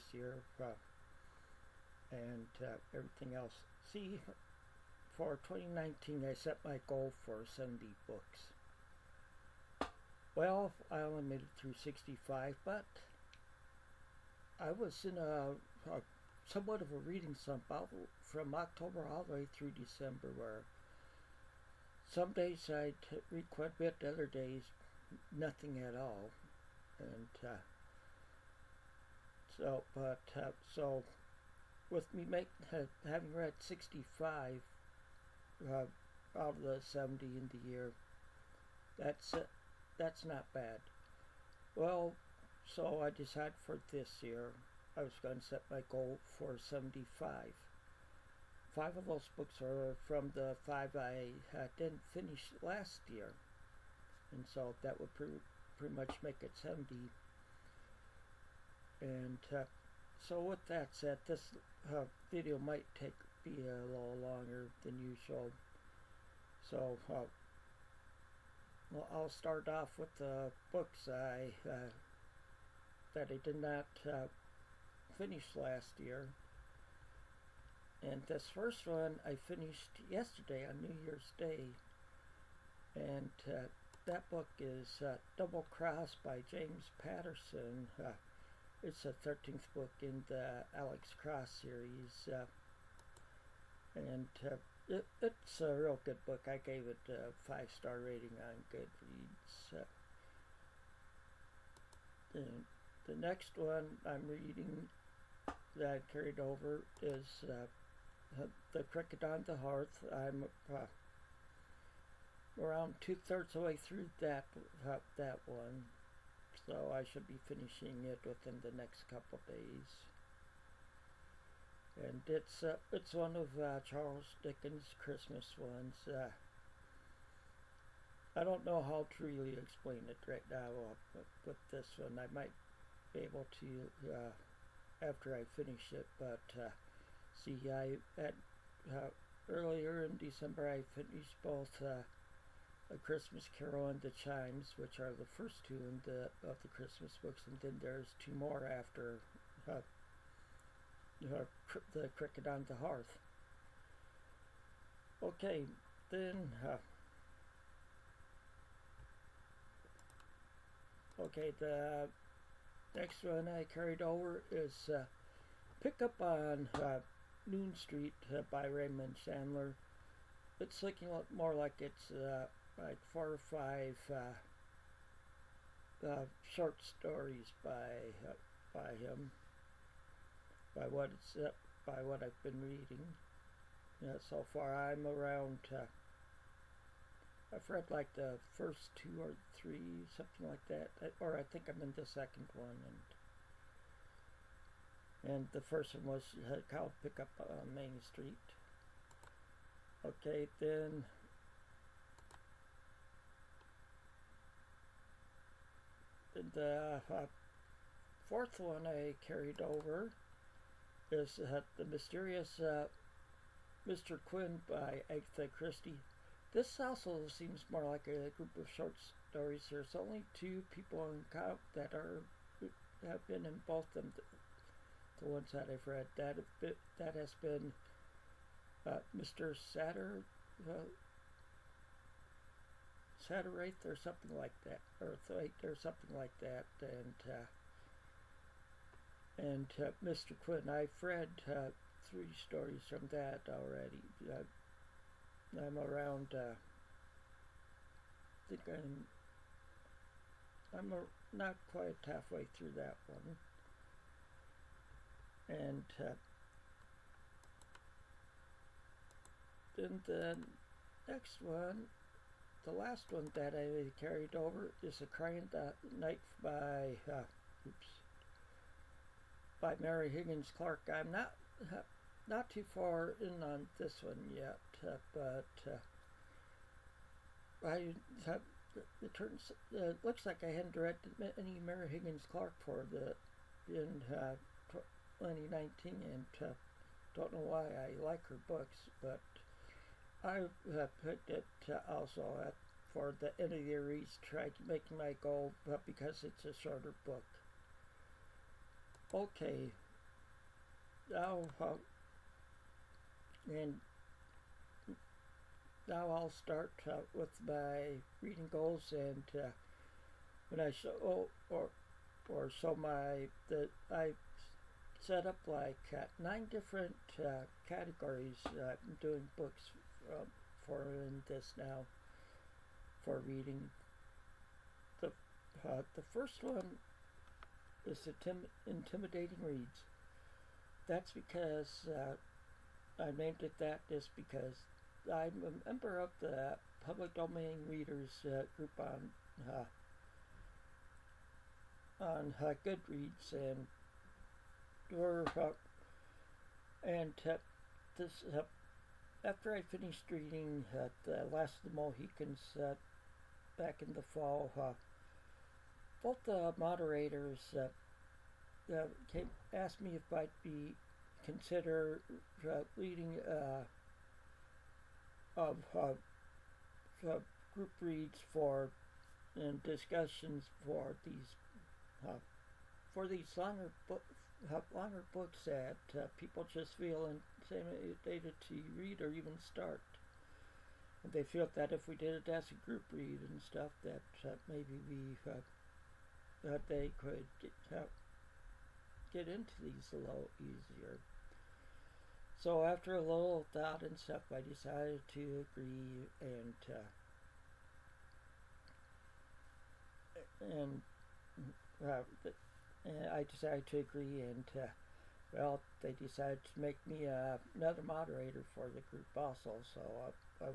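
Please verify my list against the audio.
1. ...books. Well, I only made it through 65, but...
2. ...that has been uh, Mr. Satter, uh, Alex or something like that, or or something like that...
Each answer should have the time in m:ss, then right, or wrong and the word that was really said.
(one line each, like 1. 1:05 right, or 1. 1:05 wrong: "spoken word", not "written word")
1. 0:08 right
2. 3:46 wrong: "Satterite", not "Alex".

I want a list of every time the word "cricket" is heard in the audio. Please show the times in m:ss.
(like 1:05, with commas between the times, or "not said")
1:48, 2:32.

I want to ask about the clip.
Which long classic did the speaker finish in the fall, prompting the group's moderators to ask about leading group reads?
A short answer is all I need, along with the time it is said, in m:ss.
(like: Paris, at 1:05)
The Last of the Mohicans, at 5:51.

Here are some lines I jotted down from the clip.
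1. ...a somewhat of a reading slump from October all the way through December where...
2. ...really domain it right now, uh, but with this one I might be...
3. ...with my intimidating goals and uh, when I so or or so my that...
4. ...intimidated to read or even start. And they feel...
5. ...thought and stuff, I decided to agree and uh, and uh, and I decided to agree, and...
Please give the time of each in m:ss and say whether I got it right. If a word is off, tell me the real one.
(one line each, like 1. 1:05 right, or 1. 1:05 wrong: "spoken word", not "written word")
1. 0:15 right
2. 2:09 wrong: "explain", not "domain"
3. 5:07 wrong: "reading", not "intimidating"
4. 6:17 right
5. 6:33 right.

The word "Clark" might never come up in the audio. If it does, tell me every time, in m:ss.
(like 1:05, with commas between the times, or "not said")
4:30, 4:42.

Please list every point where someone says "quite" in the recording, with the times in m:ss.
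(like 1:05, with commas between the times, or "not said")
0:23, 4:11.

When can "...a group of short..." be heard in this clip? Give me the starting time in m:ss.
3:38.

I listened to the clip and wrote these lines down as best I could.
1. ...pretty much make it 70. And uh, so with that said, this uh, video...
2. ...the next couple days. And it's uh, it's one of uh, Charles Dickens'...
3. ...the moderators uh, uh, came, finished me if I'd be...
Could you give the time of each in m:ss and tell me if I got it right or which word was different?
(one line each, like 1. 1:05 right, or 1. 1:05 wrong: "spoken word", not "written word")
1. 0:55 right
2. 1:58 right
3. 5:56 wrong: "asked", not "finished".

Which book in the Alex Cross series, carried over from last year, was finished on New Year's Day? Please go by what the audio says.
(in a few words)
Double Cross.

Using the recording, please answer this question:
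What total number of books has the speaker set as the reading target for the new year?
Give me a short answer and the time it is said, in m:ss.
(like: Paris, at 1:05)
75, at 0:46.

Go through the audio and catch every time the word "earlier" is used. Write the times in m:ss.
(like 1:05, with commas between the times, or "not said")
2:19.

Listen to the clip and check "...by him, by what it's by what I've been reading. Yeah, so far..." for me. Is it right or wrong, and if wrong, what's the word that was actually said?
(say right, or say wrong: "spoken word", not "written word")
right.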